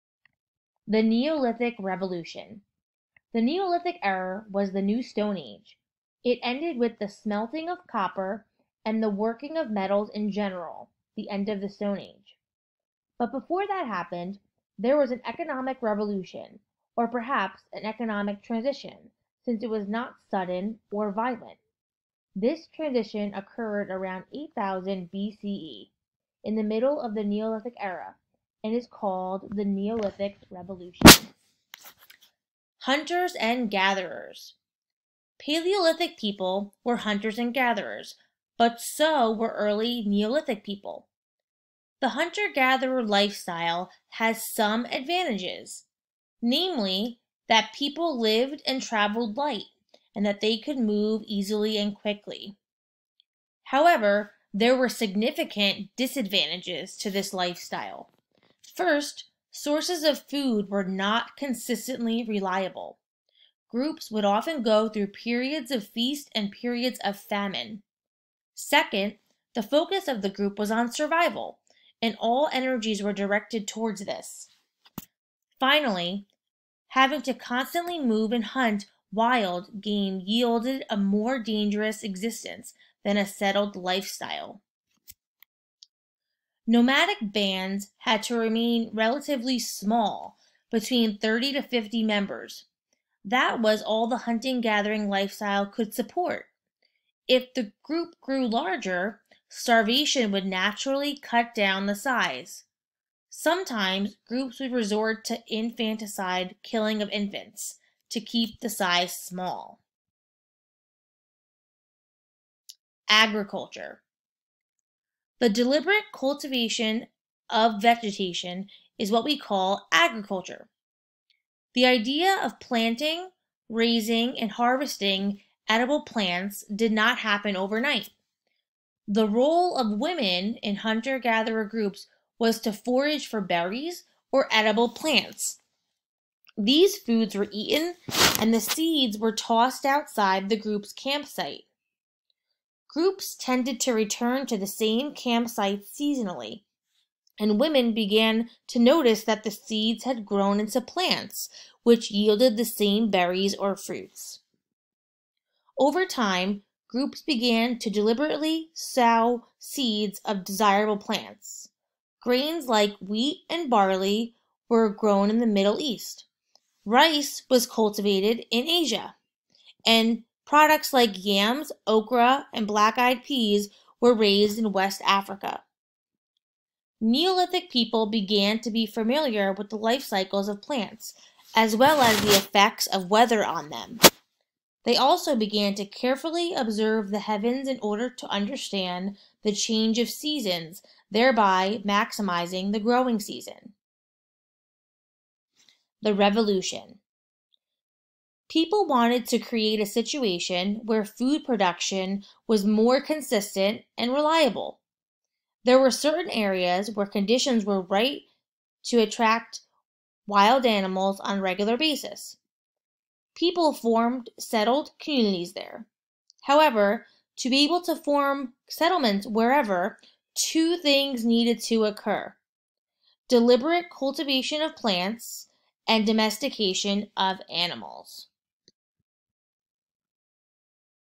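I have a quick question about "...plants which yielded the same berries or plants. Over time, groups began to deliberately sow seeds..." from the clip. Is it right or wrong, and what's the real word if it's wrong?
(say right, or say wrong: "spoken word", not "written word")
wrong: "fruits", not "plants".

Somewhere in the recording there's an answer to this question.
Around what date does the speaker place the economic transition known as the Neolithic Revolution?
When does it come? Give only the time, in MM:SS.
00:24.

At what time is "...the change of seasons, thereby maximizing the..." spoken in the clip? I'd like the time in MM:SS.
03:09.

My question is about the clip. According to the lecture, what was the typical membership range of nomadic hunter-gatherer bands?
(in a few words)
30 to 50.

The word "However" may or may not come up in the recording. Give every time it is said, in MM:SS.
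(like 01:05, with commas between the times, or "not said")
00:53, 03:36.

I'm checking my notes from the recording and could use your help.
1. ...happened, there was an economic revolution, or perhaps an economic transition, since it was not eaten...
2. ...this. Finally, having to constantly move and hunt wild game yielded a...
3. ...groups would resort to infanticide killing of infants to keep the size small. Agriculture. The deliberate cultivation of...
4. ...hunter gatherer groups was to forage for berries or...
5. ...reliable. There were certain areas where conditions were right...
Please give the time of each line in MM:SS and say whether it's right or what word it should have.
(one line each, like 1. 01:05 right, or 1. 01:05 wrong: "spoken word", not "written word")
1. 00:13 wrong: "sudden", not "eaten"
2. 01:14 right
3. 01:44 right
4. 02:10 right
5. 03:24 right.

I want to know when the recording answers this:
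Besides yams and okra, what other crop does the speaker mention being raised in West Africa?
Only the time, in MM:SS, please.
02:52.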